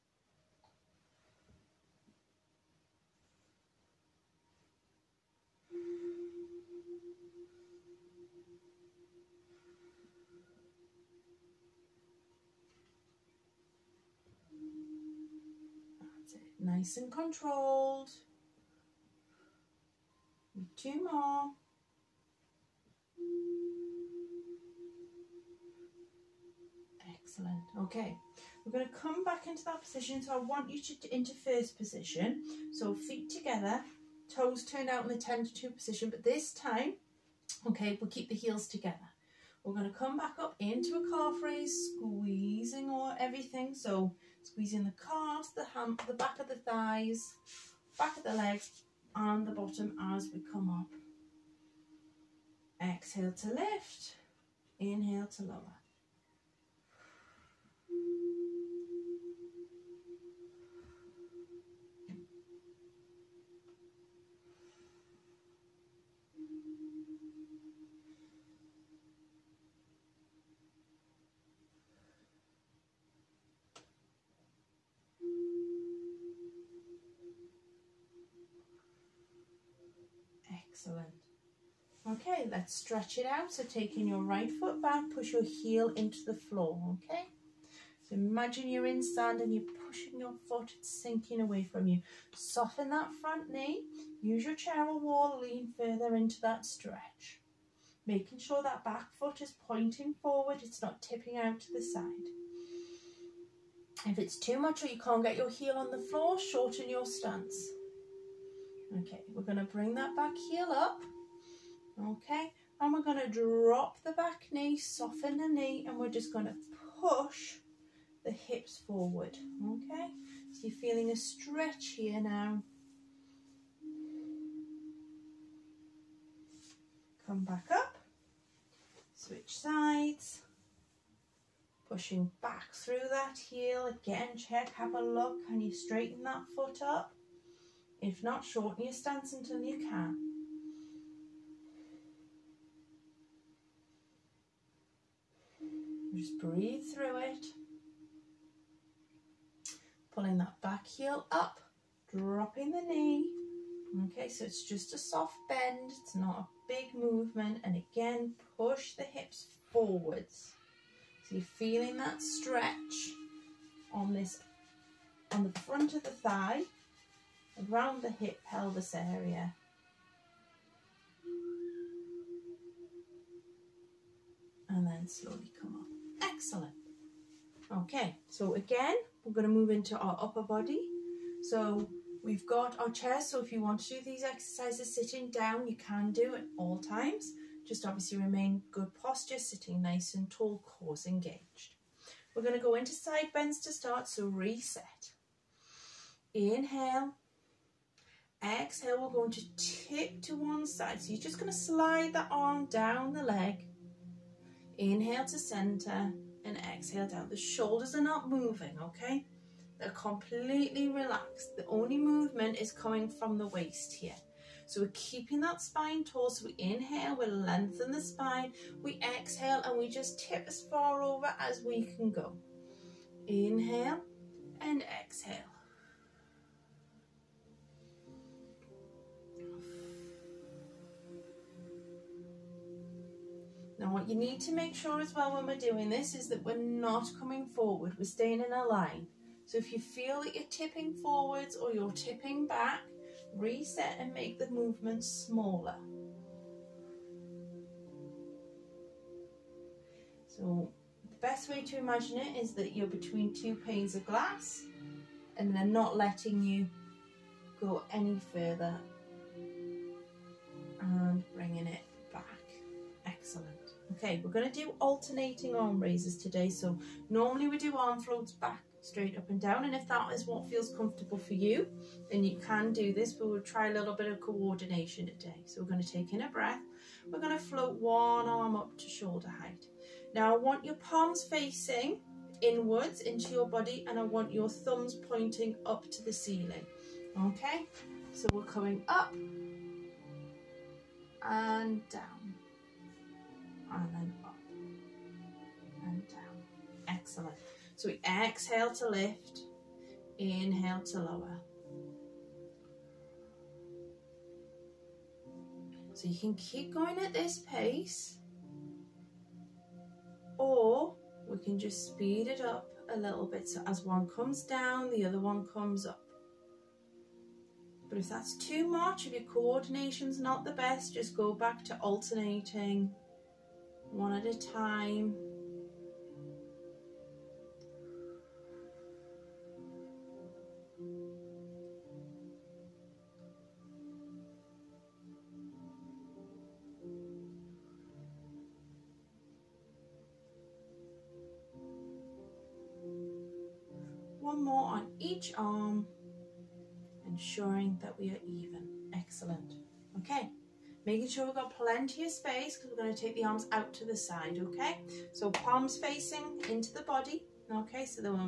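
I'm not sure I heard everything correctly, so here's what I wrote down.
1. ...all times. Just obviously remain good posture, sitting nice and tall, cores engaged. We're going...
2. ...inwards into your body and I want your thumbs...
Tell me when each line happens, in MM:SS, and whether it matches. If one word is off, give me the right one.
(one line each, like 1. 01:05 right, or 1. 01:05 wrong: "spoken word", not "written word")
1. 03:06 right
2. 04:42 right.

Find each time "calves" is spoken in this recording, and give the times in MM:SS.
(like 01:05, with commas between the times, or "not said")
00:44.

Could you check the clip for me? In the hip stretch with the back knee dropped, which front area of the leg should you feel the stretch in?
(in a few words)
front of the thigh.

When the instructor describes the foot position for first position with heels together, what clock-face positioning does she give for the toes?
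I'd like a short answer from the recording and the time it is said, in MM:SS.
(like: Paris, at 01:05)
10 to 2, at 00:35.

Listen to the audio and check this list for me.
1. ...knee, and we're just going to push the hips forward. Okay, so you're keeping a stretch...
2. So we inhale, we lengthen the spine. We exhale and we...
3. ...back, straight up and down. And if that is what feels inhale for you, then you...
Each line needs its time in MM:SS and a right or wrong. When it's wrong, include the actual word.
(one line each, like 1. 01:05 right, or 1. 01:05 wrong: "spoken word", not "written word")
1. 01:55 wrong: "feeling", not "keeping"
2. 03:36 right
3. 04:28 wrong: "comfortable", not "inhale".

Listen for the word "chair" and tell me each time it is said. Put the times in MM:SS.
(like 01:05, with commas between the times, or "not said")
01:34, 03:02.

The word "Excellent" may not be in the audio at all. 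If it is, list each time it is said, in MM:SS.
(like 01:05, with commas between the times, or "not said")
00:27, 01:20, 02:56, 04:56, 05:48.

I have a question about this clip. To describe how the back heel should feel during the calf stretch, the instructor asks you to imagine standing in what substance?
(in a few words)
sand.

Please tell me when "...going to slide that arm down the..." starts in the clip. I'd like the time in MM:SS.
03:21.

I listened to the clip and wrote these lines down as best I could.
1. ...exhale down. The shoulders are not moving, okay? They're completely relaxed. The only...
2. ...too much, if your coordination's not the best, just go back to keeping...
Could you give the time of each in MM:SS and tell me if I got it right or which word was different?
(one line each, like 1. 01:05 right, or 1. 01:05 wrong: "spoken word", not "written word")
1. 03:26 right
2. 05:18 wrong: "alternating", not "keeping".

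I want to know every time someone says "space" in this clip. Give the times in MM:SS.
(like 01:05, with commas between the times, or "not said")
05:52.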